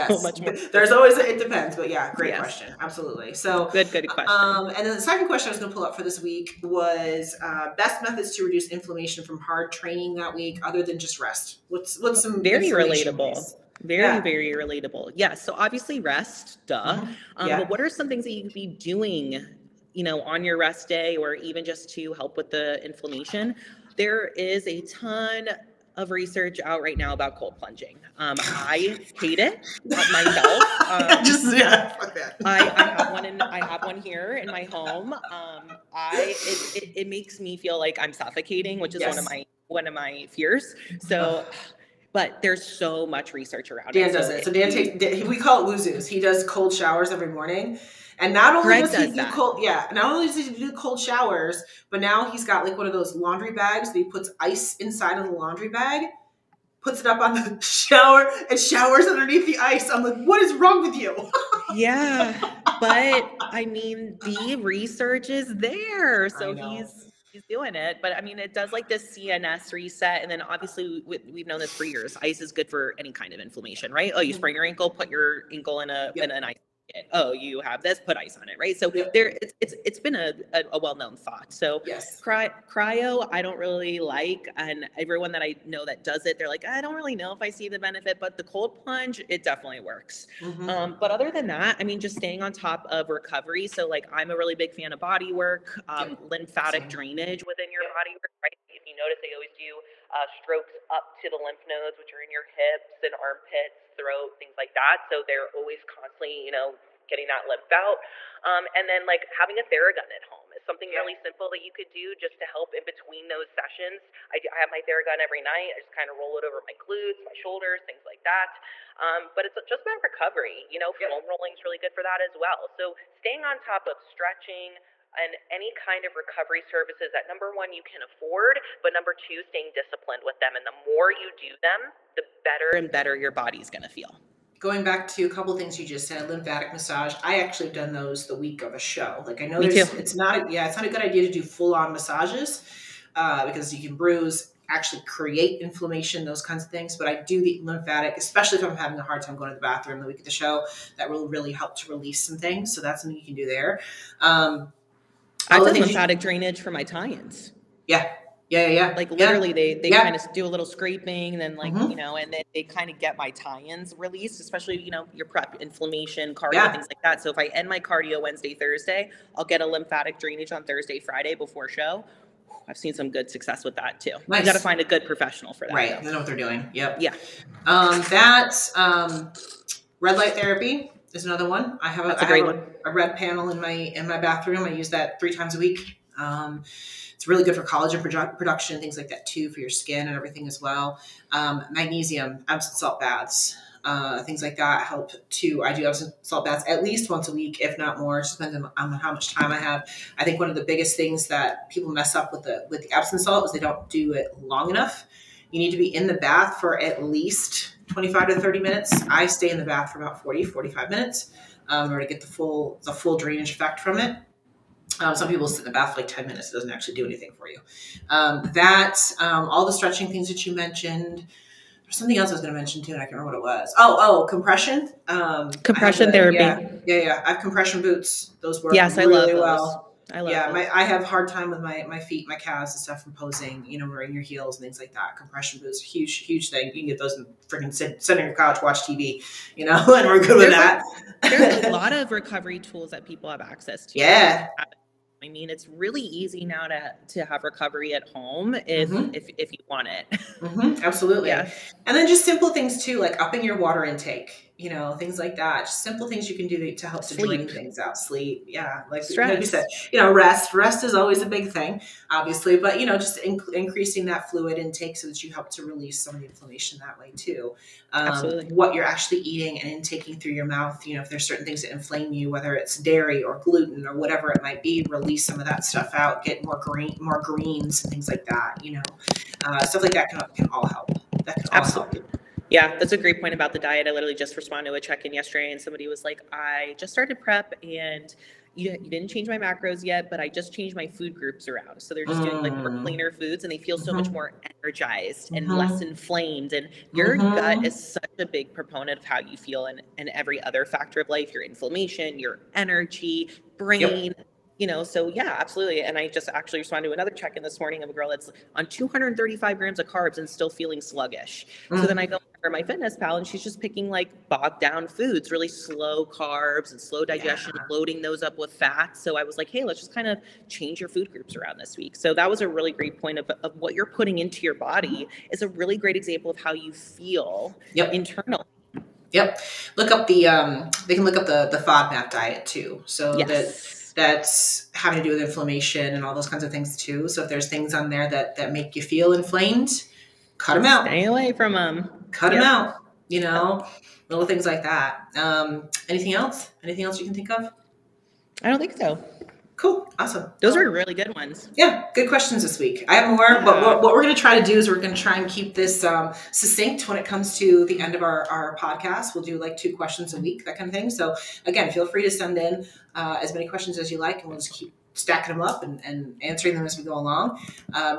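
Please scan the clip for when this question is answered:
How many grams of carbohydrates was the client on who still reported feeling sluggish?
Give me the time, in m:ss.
5:08.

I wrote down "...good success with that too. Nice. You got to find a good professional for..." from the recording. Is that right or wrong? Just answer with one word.
right.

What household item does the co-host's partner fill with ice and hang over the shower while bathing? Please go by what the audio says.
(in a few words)
Laundry bag.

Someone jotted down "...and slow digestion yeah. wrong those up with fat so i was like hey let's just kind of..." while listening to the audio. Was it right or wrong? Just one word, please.
wrong.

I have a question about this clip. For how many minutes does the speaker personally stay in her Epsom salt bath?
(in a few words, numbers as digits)
40 to 45 minutes.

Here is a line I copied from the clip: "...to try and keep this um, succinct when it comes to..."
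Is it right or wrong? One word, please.
right.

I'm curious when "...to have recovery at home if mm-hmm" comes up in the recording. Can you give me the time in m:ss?
4:07.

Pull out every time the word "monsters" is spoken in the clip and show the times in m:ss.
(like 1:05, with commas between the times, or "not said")
not said.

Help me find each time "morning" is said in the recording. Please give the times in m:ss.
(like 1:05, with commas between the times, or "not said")
0:47, 5:07.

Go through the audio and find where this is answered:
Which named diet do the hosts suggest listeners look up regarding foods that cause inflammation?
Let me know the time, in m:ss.
5:31.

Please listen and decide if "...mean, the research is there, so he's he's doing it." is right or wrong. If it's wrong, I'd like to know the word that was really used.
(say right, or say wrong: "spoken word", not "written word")
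right.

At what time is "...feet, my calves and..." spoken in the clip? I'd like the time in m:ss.
3:51.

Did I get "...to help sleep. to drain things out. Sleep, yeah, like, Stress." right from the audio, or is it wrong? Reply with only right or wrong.
right.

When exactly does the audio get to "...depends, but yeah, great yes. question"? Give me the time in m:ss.
0:01.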